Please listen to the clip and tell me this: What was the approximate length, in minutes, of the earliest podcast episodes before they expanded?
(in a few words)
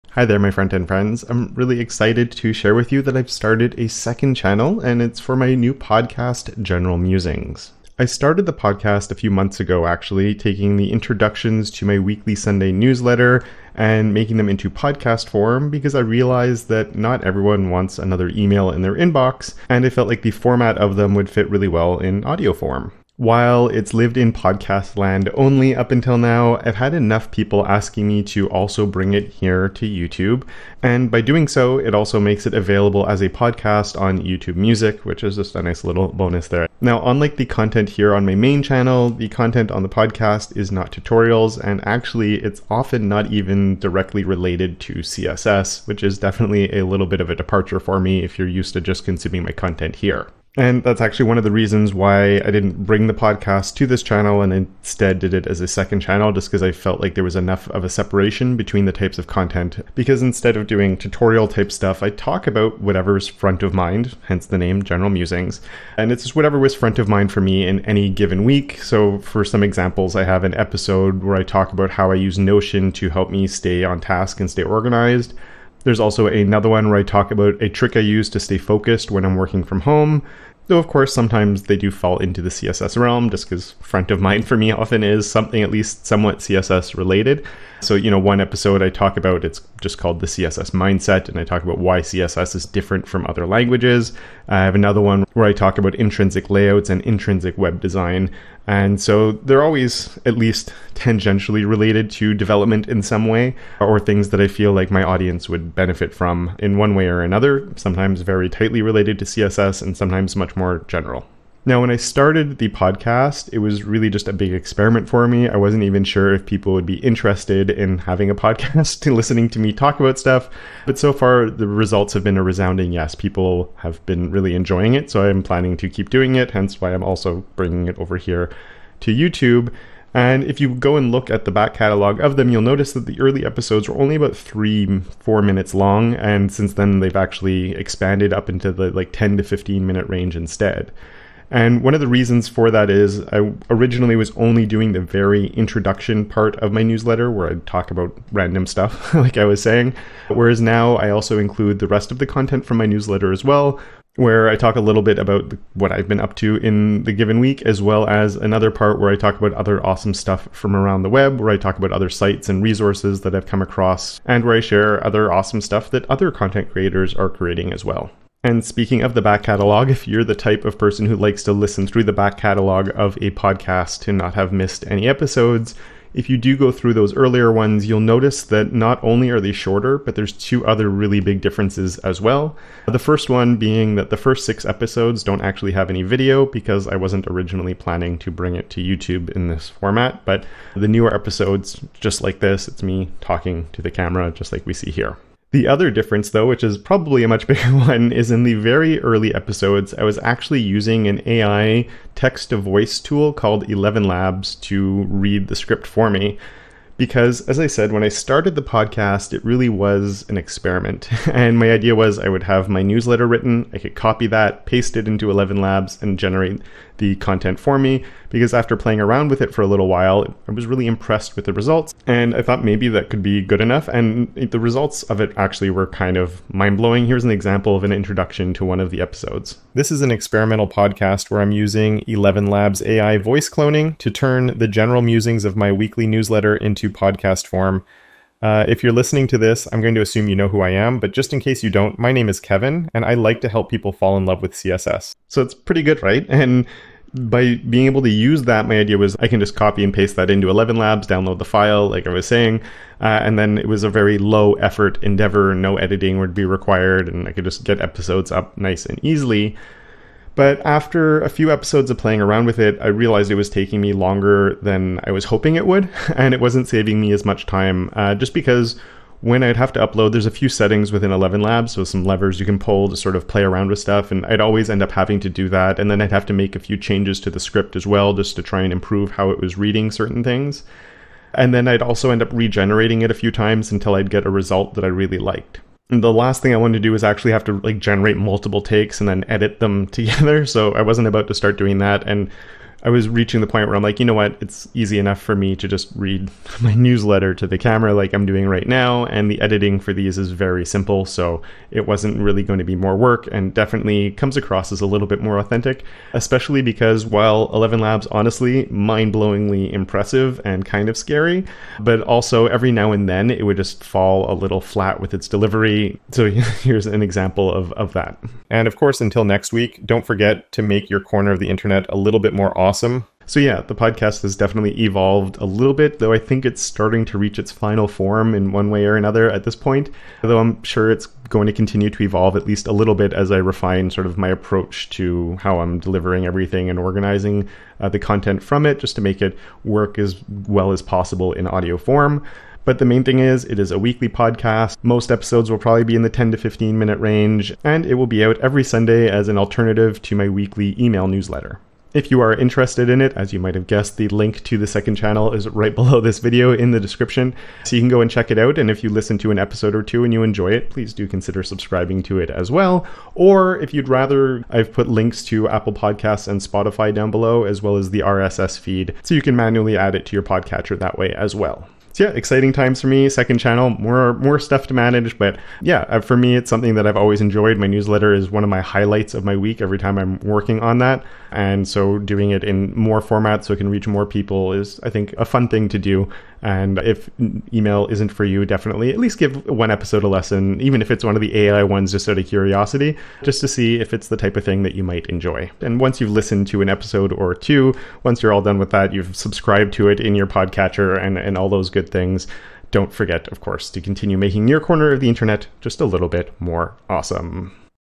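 3-4 minutes.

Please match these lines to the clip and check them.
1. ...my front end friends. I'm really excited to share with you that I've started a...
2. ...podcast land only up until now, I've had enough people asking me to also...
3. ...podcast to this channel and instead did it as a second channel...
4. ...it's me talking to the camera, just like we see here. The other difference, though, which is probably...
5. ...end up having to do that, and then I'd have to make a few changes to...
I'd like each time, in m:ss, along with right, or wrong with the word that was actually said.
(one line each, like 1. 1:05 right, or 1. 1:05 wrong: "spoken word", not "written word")
1. 0:00 right
2. 0:24 right
3. 0:53 right
4. 3:12 right
5. 4:34 right.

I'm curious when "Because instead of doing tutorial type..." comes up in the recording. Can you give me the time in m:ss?
0:59.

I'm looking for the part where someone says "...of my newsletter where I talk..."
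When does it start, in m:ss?
2:26.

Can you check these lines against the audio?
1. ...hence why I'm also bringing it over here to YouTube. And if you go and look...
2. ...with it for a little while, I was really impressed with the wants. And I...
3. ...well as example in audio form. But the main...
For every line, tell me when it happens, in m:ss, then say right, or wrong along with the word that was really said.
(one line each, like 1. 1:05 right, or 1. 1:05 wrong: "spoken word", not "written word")
1. 2:06 right
2. 3:39 wrong: "results", not "wants"
3. 5:40 wrong: "possible", not "example".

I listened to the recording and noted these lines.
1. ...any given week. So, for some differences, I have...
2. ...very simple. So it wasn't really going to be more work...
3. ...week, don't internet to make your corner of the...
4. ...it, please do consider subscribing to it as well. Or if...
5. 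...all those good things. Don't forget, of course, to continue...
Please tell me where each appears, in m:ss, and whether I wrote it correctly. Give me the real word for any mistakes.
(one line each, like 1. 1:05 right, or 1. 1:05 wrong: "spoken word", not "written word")
1. 1:07 wrong: "examples", not "differences"
2. 5:00 right
3. 5:19 wrong: "forget", not "internet"
4. 6:00 right
5. 6:41 right.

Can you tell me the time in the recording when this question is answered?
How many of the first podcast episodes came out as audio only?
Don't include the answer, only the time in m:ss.
3:04.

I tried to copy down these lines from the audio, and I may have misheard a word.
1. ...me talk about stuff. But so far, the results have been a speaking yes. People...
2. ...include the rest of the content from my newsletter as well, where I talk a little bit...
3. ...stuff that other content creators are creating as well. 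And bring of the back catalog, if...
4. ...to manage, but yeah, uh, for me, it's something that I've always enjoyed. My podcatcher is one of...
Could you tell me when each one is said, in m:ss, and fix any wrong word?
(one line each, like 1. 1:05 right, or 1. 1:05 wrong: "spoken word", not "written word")
1. 1:59 wrong: "resounding", not "speaking"
2. 2:31 right
3. 2:45 wrong: "speaking", not "bring"
4. 6:14 wrong: "newsletter", not "podcatcher".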